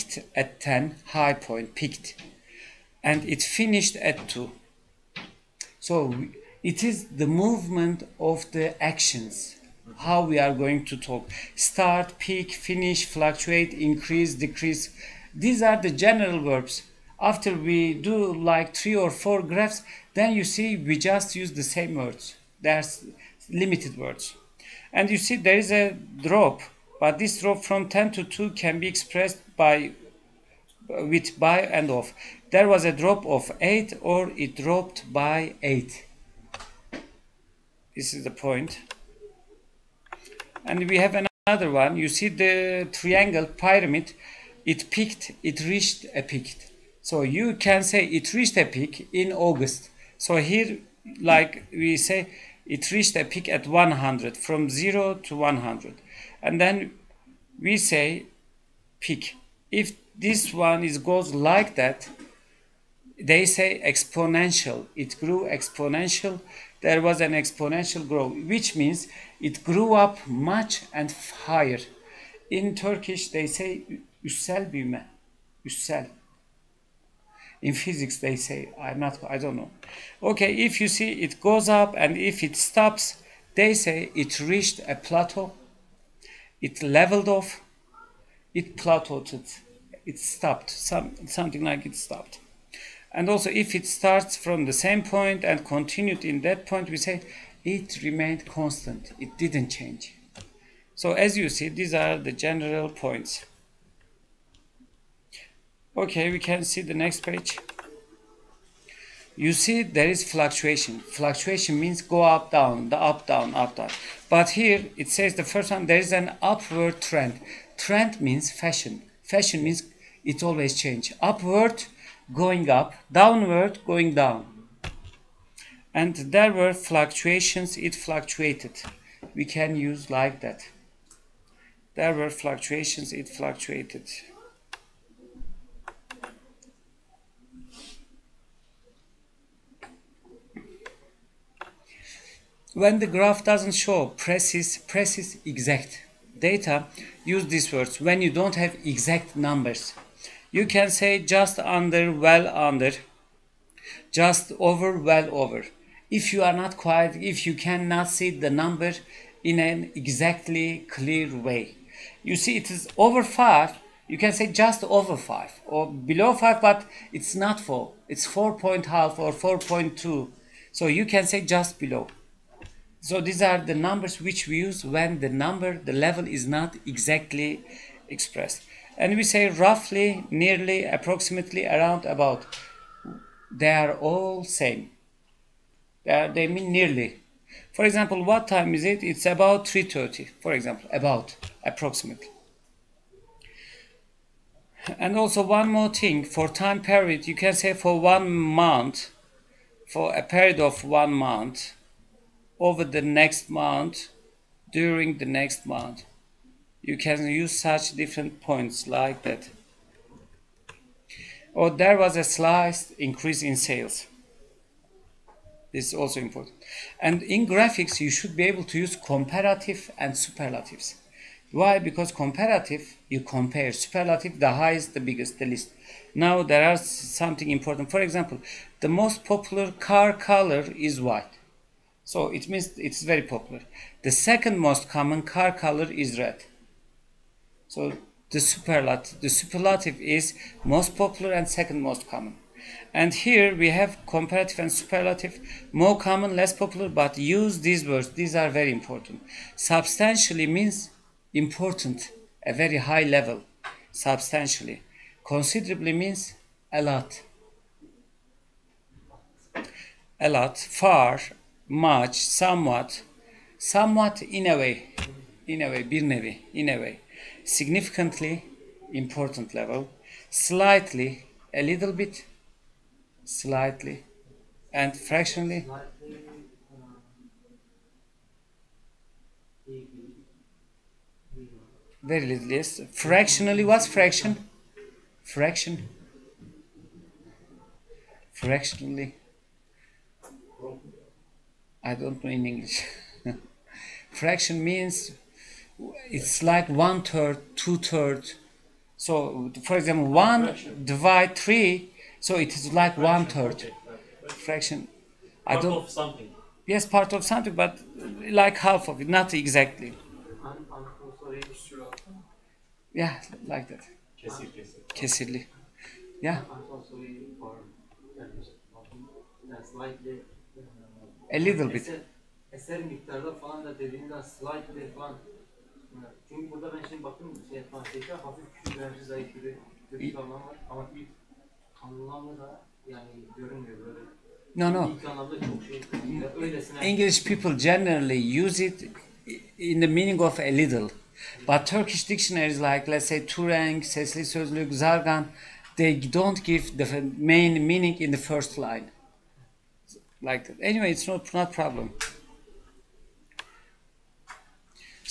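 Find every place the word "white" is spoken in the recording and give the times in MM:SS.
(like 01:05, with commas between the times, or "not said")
03:51.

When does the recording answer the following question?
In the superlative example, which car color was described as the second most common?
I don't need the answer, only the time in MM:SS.
03:56.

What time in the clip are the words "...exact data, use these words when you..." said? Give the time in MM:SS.
02:25.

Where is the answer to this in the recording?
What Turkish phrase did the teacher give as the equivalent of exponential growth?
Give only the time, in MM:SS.
01:14.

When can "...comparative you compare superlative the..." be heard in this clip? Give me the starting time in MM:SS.
03:42.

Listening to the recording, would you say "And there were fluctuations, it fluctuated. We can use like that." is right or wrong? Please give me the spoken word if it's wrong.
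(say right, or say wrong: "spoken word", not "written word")
right.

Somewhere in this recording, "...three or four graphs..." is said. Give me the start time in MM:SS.
00:18.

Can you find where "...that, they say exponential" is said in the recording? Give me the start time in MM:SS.
01:01.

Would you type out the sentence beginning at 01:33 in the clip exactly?
And also if it starts from the same point and continued in that point, we say it remained constant.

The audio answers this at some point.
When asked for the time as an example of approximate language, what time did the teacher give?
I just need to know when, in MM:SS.
03:09.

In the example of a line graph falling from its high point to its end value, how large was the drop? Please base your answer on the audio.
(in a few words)
8.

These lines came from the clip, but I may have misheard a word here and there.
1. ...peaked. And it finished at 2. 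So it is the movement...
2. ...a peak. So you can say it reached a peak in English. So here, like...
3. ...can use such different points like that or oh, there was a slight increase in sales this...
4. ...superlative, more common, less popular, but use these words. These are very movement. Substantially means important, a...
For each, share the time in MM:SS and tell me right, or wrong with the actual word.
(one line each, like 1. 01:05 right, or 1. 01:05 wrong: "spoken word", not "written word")
1. 00:01 right
2. 00:46 wrong: "August", not "English"
3. 03:26 right
4. 04:04 wrong: "important", not "movement".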